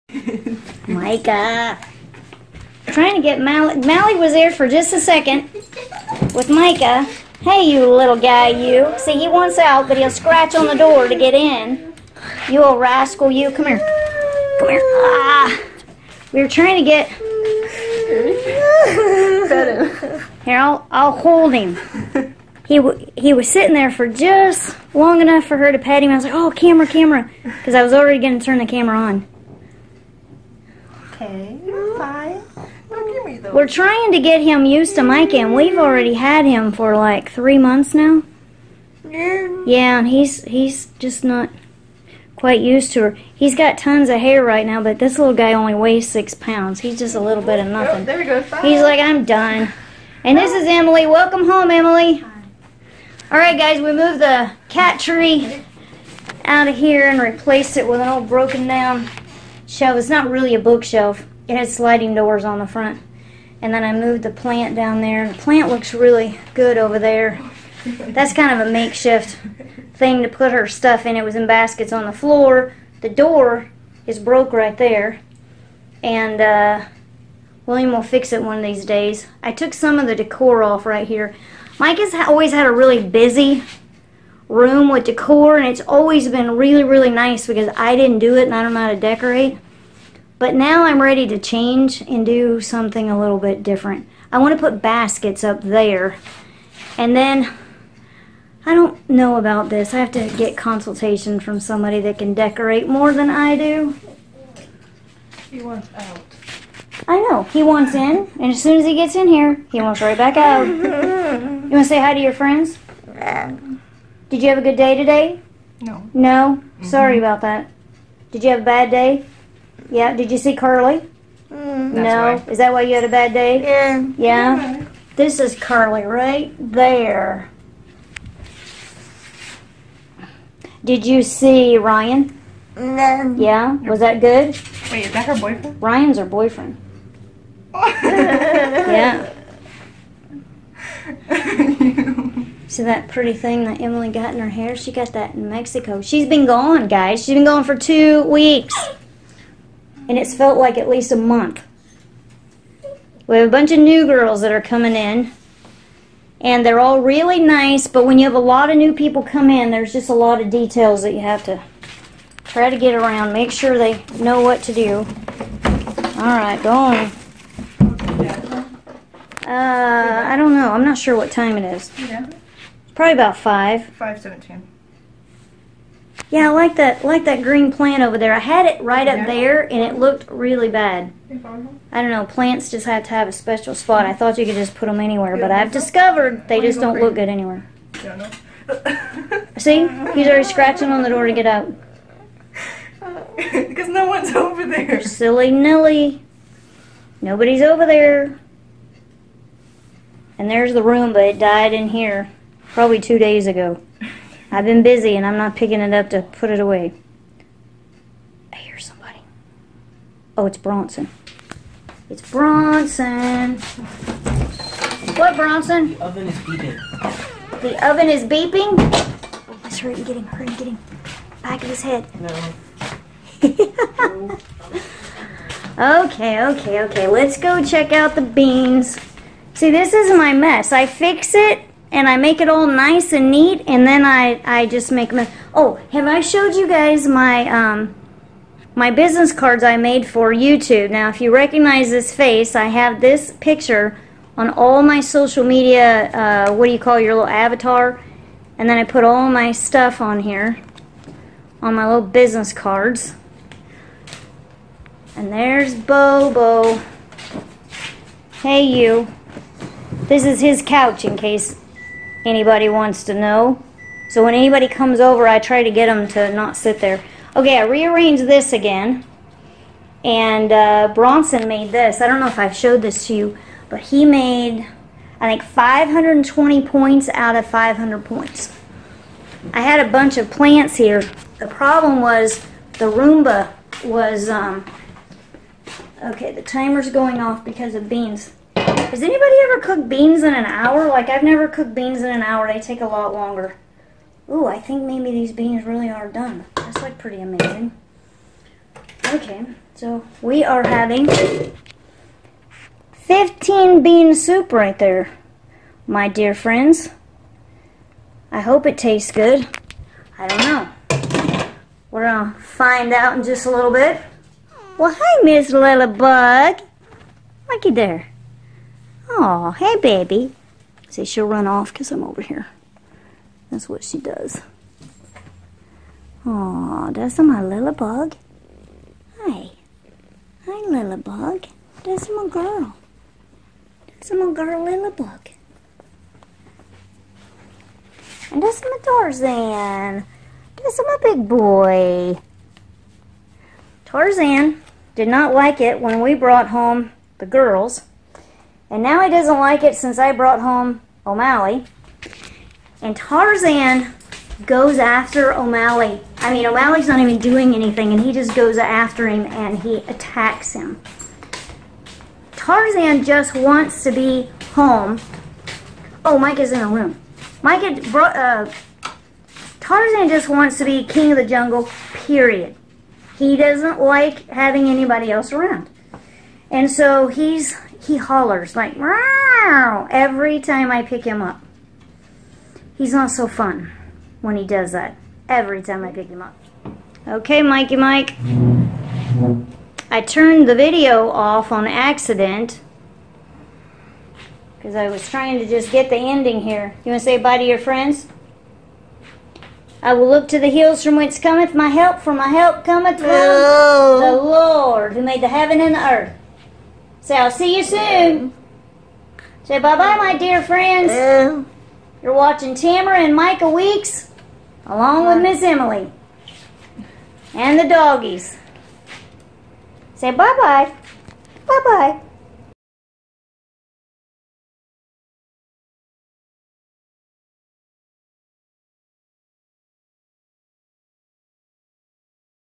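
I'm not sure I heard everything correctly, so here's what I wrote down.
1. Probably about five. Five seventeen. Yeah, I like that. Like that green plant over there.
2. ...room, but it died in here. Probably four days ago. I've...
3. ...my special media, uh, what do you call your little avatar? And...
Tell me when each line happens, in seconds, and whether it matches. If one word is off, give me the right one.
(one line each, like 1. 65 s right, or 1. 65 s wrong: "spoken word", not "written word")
1. 173 s right
2. 200 s wrong: "two", not "four"
3. 244 s wrong: "social", not "special".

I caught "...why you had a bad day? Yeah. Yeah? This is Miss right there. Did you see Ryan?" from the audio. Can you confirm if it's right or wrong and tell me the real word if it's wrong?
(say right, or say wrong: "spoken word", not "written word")
wrong: "Curly", not "Miss".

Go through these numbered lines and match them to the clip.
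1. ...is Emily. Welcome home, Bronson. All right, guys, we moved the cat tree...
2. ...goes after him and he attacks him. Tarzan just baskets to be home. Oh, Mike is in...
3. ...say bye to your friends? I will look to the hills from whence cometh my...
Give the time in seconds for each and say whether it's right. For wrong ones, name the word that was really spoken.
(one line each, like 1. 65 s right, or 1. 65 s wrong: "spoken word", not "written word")
1. 50 s wrong: "Emily", not "Bronson"
2. 358 s wrong: "wants", not "baskets"
3. 397 s right.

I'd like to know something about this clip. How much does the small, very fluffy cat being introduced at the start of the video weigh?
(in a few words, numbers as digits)
6 pounds.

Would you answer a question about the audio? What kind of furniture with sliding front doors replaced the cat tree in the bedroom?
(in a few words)
Shelf.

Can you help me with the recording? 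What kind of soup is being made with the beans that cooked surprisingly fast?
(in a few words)
15 bean soup.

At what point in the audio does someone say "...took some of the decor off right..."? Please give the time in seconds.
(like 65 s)
79 s.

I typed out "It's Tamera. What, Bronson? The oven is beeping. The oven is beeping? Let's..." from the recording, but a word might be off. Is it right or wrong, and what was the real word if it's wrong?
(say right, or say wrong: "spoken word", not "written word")
wrong: "Bronson", not "Tamera".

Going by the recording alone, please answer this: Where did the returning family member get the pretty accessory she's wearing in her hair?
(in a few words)
Mexico.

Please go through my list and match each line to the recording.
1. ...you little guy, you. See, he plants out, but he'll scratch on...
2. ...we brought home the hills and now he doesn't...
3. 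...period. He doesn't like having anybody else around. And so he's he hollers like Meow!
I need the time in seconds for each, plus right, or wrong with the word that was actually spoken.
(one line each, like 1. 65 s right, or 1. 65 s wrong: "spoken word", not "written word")
1. 7 s wrong: "wants", not "plants"
2. 345 s wrong: "girls", not "hills"
3. 371 s right.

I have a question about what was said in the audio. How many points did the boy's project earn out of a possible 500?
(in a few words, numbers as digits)
520.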